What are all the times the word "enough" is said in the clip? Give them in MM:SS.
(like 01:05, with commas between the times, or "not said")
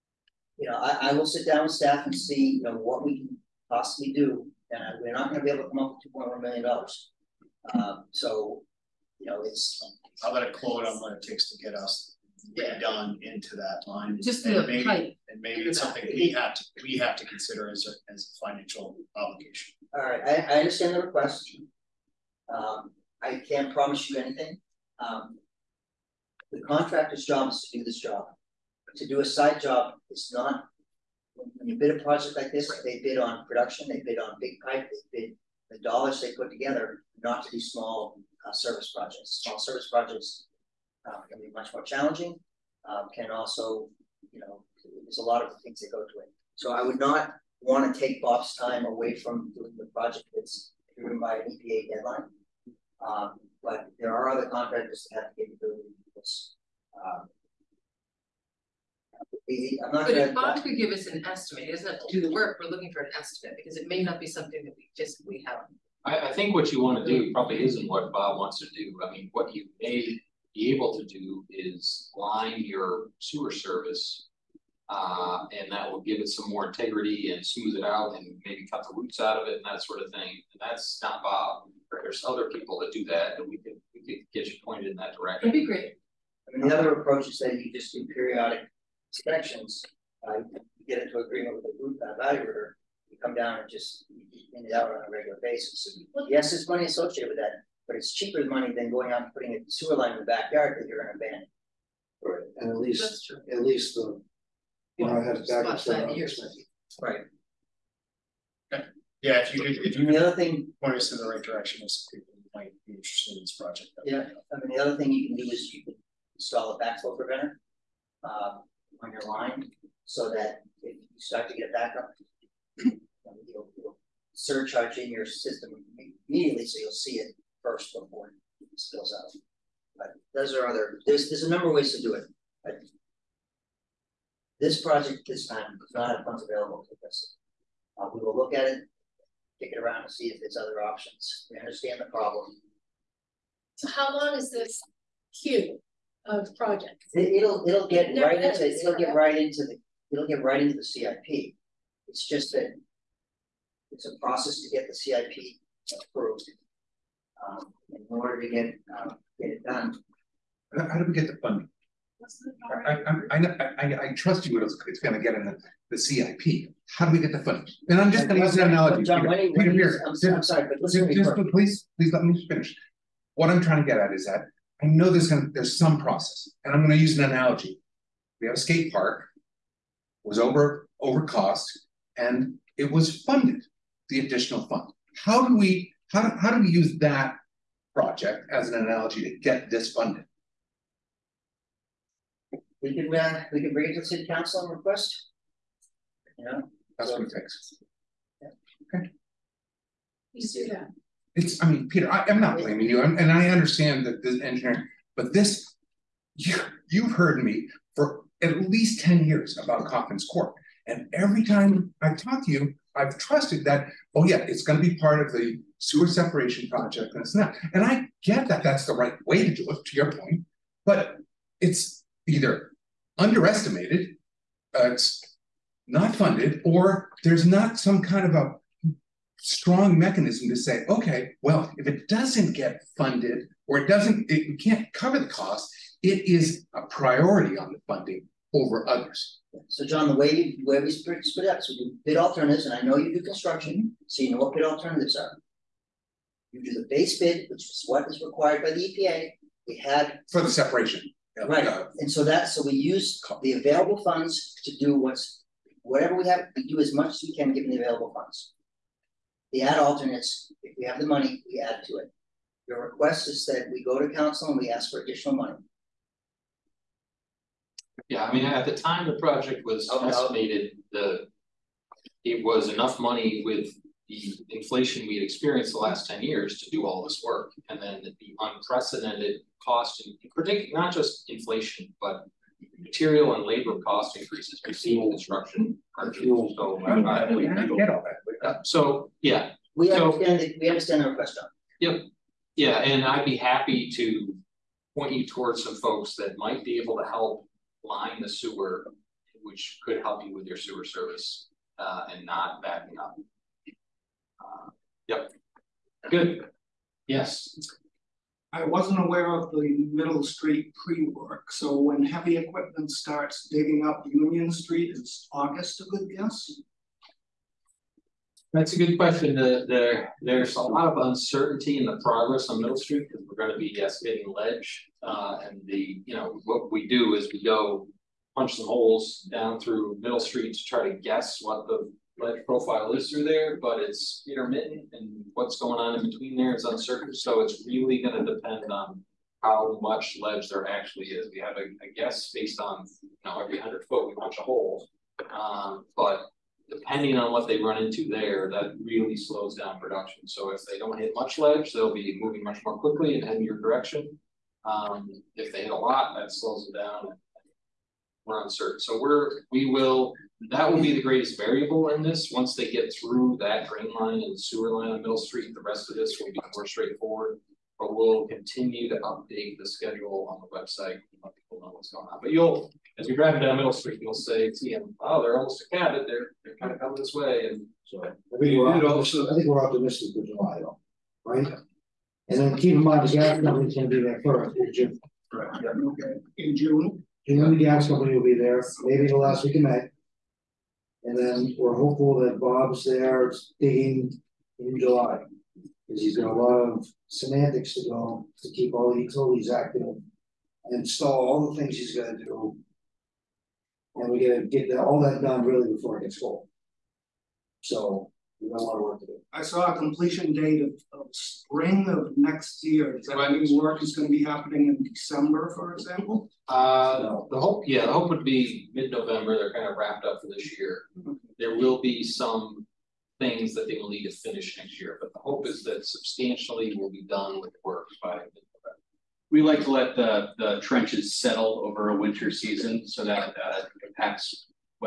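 04:32.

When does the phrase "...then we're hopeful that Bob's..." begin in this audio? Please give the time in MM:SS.
06:31.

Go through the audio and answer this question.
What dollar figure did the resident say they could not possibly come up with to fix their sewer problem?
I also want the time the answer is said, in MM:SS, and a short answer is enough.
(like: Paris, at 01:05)
$2.1 million, at 00:06.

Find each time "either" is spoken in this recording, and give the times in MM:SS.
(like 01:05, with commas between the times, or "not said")
03:42.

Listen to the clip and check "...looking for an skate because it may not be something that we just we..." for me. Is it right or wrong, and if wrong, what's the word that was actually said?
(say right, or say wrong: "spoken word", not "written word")
wrong: "estimate", not "skate".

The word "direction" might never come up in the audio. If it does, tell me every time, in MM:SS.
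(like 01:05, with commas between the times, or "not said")
01:25, 01:51, 05:53.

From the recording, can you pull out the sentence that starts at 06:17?
And so we I think we're optimistic for July, though, right?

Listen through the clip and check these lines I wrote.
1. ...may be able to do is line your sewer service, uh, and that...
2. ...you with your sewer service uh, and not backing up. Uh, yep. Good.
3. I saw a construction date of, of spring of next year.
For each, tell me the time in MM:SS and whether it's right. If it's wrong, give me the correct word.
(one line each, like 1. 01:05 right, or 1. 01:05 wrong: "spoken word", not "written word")
1. 01:09 right
2. 05:00 right
3. 06:49 wrong: "completion", not "construction".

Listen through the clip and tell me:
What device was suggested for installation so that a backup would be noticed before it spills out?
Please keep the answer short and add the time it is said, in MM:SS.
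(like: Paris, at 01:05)
backflow preventer, at 01:56.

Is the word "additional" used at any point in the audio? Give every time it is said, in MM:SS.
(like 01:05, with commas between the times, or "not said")
03:04, 04:25.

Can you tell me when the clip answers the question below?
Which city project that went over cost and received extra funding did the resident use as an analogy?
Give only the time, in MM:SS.
02:58.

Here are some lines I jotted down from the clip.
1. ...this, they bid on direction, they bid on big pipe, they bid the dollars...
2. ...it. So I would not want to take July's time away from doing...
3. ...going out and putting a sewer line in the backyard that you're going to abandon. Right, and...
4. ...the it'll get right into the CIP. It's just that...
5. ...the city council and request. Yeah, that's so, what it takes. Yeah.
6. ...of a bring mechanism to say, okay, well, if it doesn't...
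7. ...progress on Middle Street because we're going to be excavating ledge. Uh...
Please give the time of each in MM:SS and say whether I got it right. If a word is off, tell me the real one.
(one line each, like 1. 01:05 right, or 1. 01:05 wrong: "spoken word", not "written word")
1. 00:32 wrong: "production", not "direction"
2. 00:46 wrong: "Bob", not "July"
3. 01:38 right
4. 02:29 right
5. 03:13 right
6. 03:48 wrong: "strong", not "bring"
7. 05:22 right.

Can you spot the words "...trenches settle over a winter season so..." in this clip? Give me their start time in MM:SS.
07:10.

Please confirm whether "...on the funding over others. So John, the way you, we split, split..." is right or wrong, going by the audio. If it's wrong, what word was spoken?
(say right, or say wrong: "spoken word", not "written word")
right.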